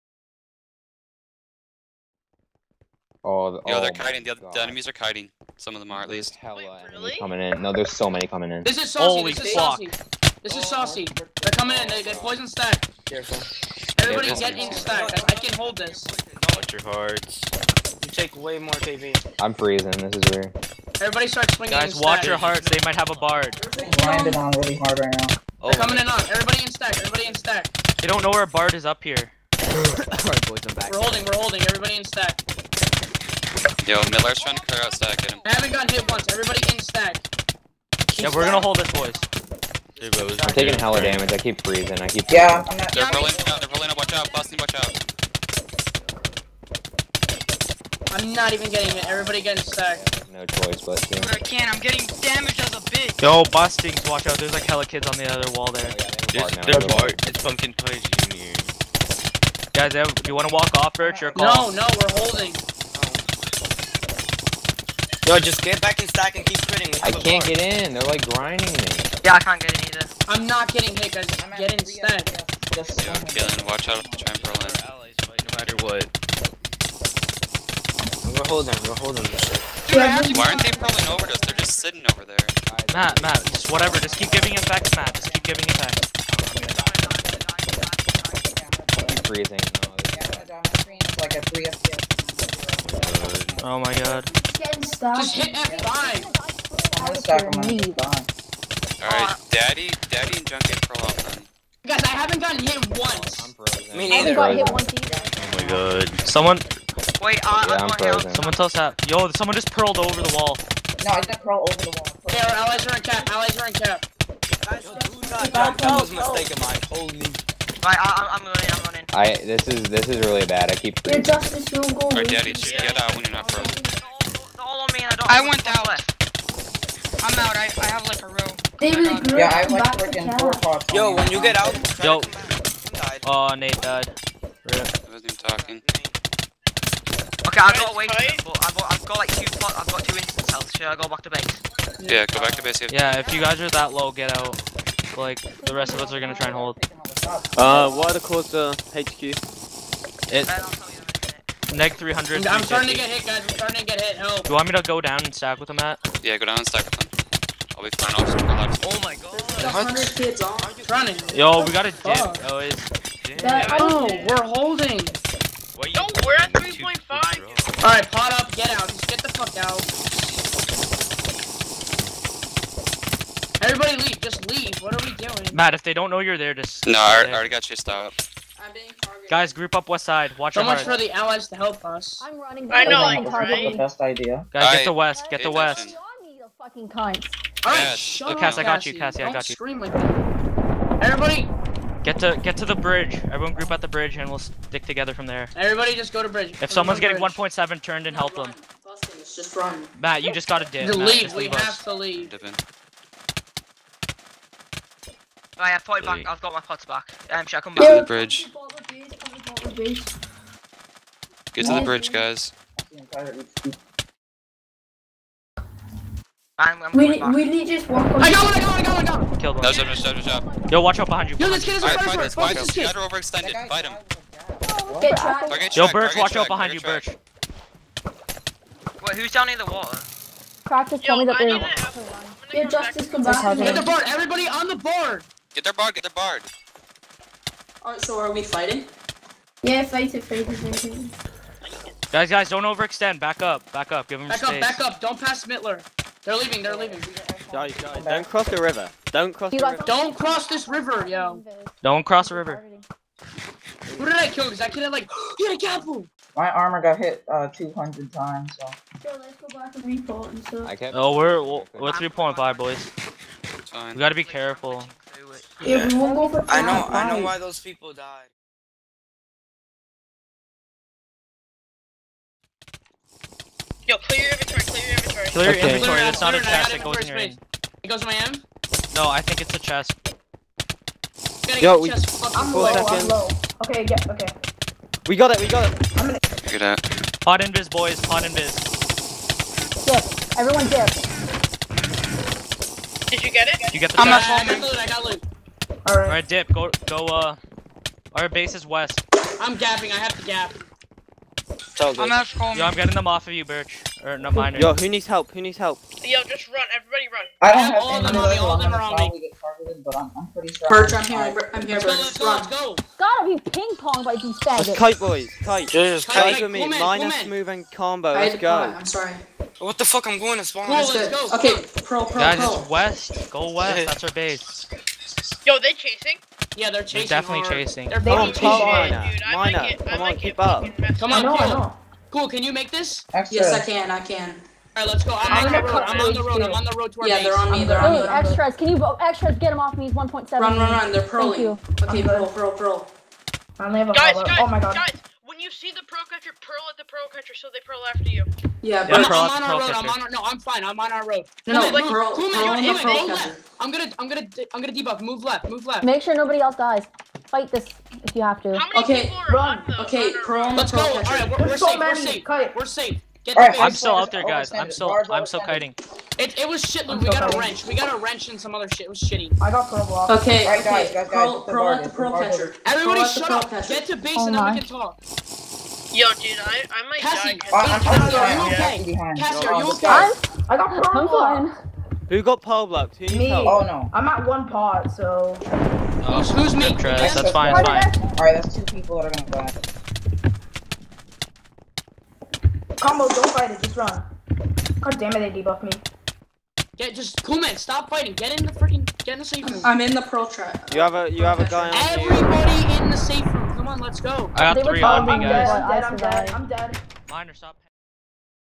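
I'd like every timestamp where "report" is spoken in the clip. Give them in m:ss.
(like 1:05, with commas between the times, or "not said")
4:19.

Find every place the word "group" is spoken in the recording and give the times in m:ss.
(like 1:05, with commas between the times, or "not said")
2:59, 3:13.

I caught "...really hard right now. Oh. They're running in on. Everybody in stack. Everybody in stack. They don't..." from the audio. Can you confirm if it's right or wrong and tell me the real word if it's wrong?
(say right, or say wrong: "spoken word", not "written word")
wrong: "coming", not "running".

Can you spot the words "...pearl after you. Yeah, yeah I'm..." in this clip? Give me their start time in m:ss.
5:47.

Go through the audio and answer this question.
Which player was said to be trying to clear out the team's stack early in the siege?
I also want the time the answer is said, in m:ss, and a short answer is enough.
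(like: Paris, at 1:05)
Miller, at 0:34.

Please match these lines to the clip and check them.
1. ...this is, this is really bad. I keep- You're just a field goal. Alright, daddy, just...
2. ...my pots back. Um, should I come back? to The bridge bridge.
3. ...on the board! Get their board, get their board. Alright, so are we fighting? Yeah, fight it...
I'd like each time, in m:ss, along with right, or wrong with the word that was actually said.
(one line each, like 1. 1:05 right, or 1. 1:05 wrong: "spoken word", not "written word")
1. 1:59 right
2. 3:26 right
3. 3:54 right.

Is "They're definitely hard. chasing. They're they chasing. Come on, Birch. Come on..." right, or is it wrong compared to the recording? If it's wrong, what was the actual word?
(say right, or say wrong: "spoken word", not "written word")
wrong: "Lina", not "Birch".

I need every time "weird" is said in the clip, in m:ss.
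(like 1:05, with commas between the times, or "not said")
0:20.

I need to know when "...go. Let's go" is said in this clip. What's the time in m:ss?
5:12.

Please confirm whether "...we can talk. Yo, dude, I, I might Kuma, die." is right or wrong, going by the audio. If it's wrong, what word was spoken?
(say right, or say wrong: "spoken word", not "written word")
wrong: "Cassie", not "Kuma".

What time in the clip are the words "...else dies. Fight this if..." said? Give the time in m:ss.
5:56.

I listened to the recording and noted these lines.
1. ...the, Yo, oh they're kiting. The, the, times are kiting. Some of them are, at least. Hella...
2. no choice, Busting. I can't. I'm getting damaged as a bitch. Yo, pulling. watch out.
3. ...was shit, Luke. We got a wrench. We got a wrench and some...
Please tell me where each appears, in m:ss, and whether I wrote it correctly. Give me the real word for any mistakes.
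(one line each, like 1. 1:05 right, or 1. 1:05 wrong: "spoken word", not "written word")
1. 0:03 wrong: "enemies", not "times"
2. 0:50 wrong: "busting", not "pulling"
3. 6:06 right.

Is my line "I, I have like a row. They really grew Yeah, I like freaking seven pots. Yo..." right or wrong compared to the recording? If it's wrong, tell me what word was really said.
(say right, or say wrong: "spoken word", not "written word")
wrong: "four", not "seven".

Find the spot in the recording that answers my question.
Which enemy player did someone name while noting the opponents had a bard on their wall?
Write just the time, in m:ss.
0:57.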